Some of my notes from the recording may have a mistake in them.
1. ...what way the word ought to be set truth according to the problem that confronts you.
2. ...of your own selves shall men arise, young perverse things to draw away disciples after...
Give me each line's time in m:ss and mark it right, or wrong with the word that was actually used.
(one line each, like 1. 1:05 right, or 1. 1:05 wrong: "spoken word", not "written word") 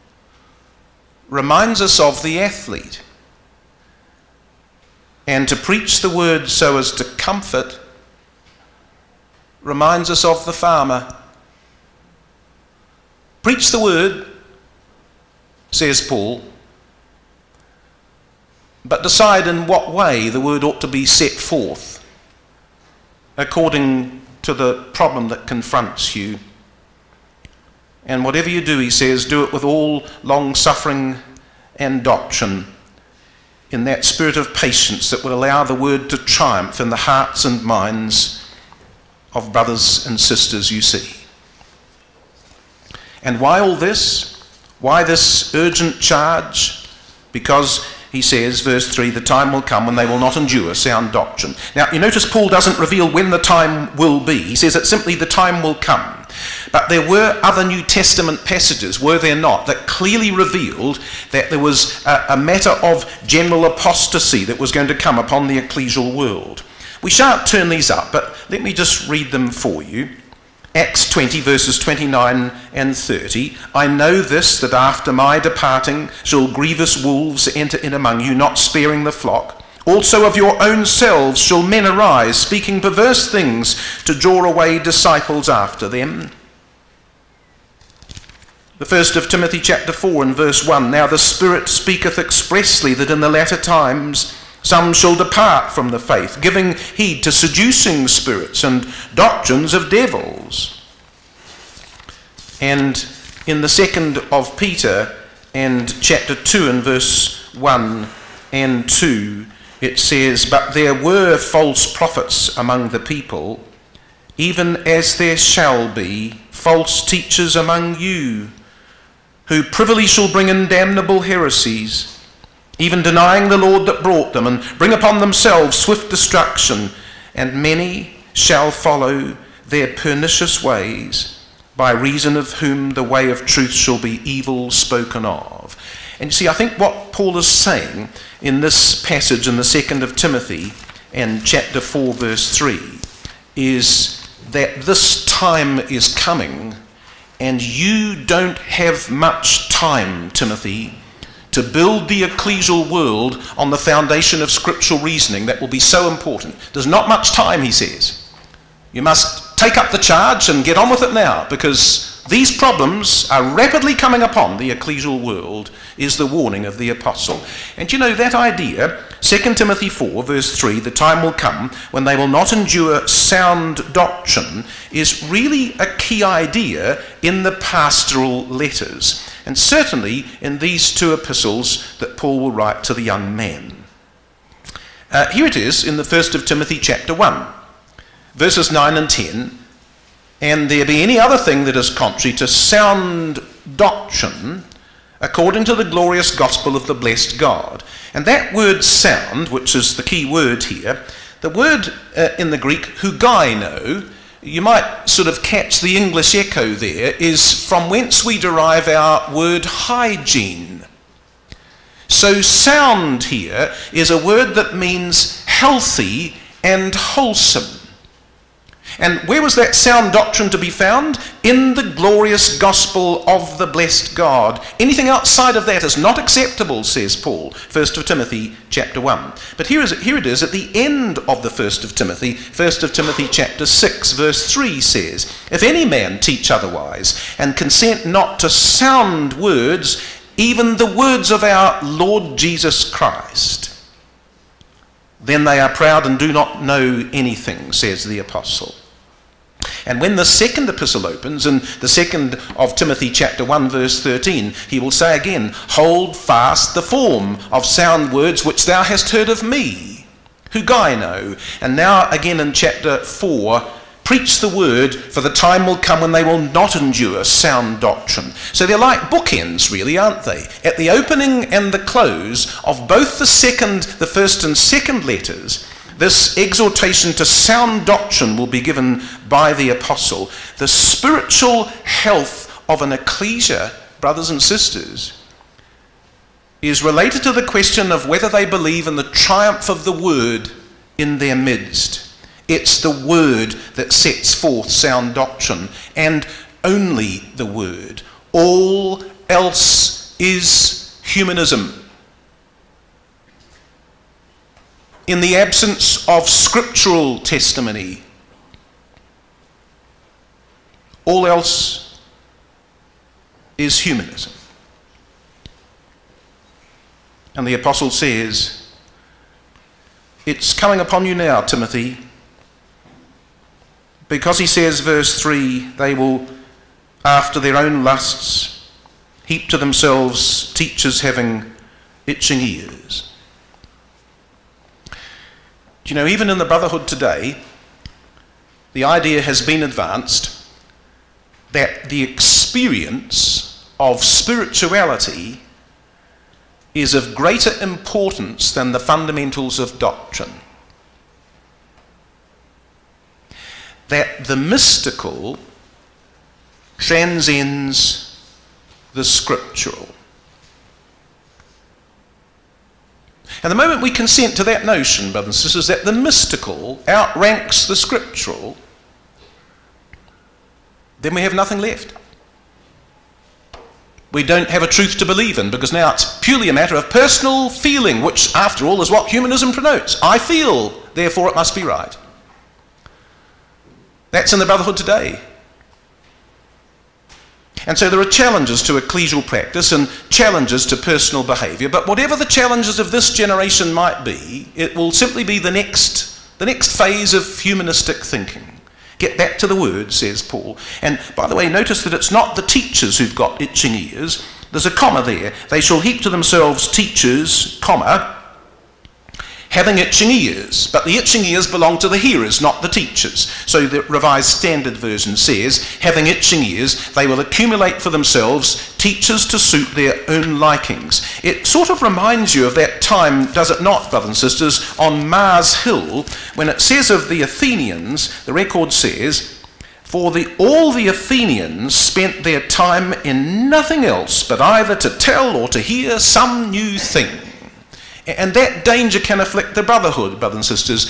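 1. 0:19 wrong: "forth", not "truth"
2. 1:20 wrong: "speaking", not "young".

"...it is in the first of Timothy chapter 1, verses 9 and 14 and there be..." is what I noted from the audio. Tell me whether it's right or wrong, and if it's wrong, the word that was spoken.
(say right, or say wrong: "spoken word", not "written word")
wrong: "10", not "14".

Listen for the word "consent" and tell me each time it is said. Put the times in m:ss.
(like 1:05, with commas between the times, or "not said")
3:57, 6:03.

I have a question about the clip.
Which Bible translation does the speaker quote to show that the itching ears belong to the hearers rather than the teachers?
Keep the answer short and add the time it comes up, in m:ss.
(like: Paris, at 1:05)
Revised Standard Version, at 6:53.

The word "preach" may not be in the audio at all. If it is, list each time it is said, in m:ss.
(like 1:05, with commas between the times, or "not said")
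0:05, 0:13, 4:24.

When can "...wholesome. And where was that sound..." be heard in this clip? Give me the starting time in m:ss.
3:36.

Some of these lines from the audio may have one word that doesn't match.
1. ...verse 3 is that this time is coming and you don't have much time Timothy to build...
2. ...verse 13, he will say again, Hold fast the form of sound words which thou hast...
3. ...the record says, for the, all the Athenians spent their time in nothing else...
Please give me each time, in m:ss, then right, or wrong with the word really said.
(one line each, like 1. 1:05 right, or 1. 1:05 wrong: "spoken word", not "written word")
1. 2:22 right
2. 4:13 right
3. 7:08 right.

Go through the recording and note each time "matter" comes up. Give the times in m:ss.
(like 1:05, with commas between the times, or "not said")
1:02, 6:16.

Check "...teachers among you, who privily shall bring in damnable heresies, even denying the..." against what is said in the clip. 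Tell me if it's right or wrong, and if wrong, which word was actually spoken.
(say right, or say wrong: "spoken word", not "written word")
right.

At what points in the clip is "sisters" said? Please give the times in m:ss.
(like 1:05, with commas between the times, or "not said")
0:40, 4:44, 6:05, 7:04.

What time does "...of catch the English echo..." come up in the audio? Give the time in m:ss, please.
3:25.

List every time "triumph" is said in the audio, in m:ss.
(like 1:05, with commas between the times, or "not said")
0:36, 4:49.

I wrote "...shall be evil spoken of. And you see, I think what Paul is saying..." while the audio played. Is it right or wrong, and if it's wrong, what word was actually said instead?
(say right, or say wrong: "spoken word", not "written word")
right.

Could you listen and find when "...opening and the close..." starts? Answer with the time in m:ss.
4:30.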